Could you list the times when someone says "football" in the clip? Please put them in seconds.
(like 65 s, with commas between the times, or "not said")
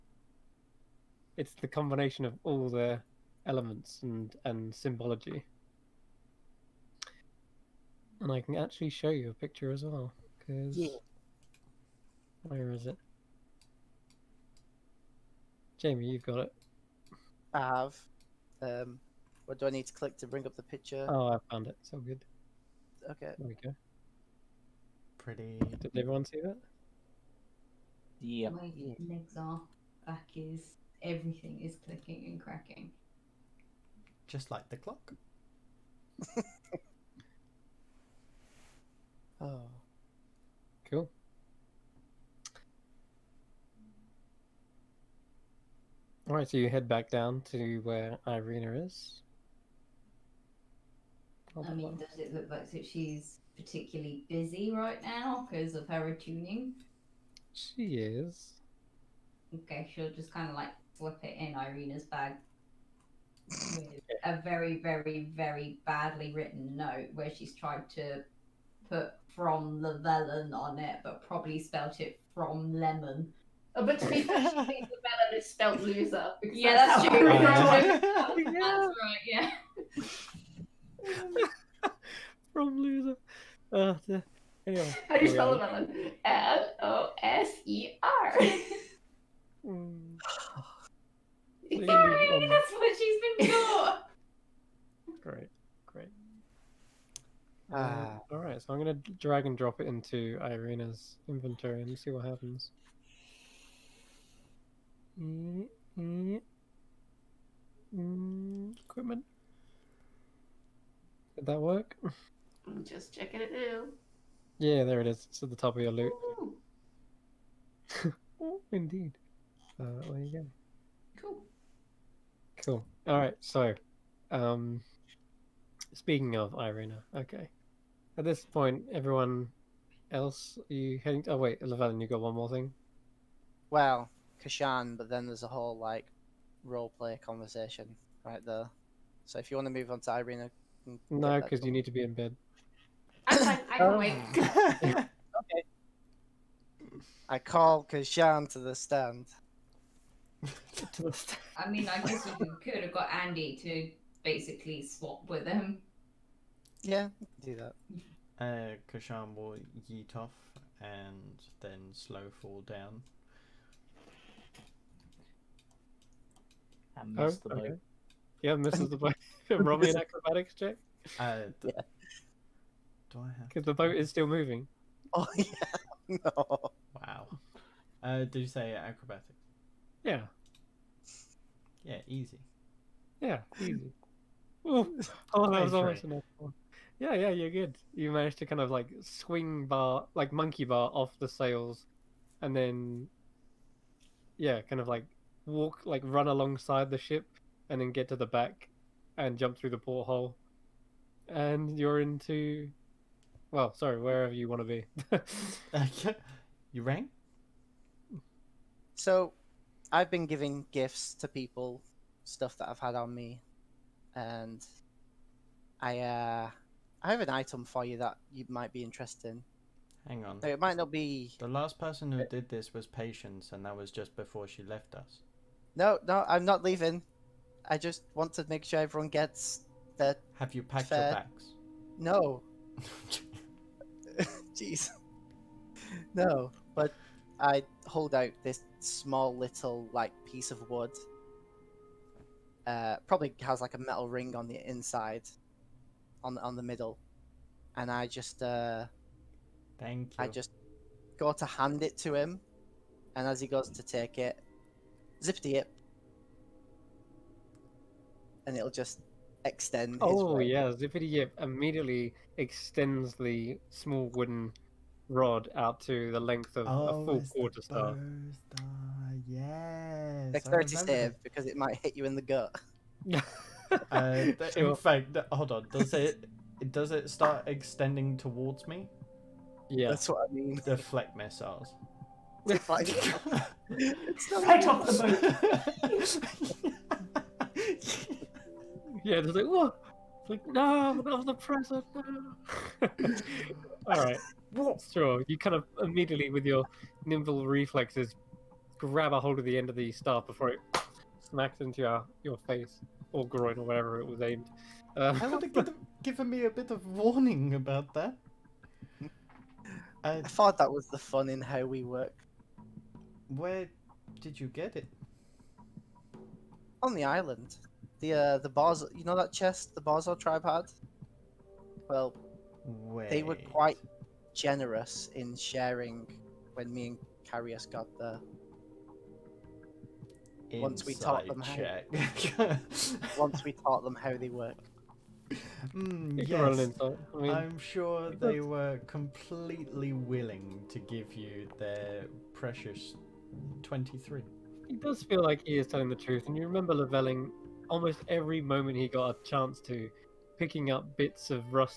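not said.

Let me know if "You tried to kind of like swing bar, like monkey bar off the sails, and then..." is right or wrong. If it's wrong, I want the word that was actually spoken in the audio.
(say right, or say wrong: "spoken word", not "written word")
wrong: "managed", not "tried".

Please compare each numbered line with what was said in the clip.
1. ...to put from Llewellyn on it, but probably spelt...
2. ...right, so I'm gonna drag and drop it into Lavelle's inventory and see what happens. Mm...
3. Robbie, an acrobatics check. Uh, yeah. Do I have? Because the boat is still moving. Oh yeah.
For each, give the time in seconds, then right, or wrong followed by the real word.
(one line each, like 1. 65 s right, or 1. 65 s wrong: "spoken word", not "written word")
1. 67 s right
2. 98 s wrong: "Irina", not "Lavelle"
3. 169 s right.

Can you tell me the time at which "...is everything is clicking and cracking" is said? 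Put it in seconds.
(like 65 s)
30 s.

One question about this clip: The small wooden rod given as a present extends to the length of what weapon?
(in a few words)
quarter staff.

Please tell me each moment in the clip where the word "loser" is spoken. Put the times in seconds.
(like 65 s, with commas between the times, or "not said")
75 s, 82 s.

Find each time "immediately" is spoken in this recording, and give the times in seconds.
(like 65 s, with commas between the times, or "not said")
261 s, 295 s.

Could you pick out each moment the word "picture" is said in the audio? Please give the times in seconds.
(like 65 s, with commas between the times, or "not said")
9 s, 20 s.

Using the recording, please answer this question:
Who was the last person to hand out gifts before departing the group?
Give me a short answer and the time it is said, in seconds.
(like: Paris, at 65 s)
Patience, at 222 s.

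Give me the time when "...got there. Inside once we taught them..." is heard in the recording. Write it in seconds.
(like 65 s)
327 s.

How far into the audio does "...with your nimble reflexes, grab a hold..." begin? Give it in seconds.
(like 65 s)
296 s.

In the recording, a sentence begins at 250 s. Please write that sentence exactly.
I just go to hand it to him, and as he goes to take it, zippity it, and it'll just extend.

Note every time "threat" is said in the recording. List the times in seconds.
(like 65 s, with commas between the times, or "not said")
not said.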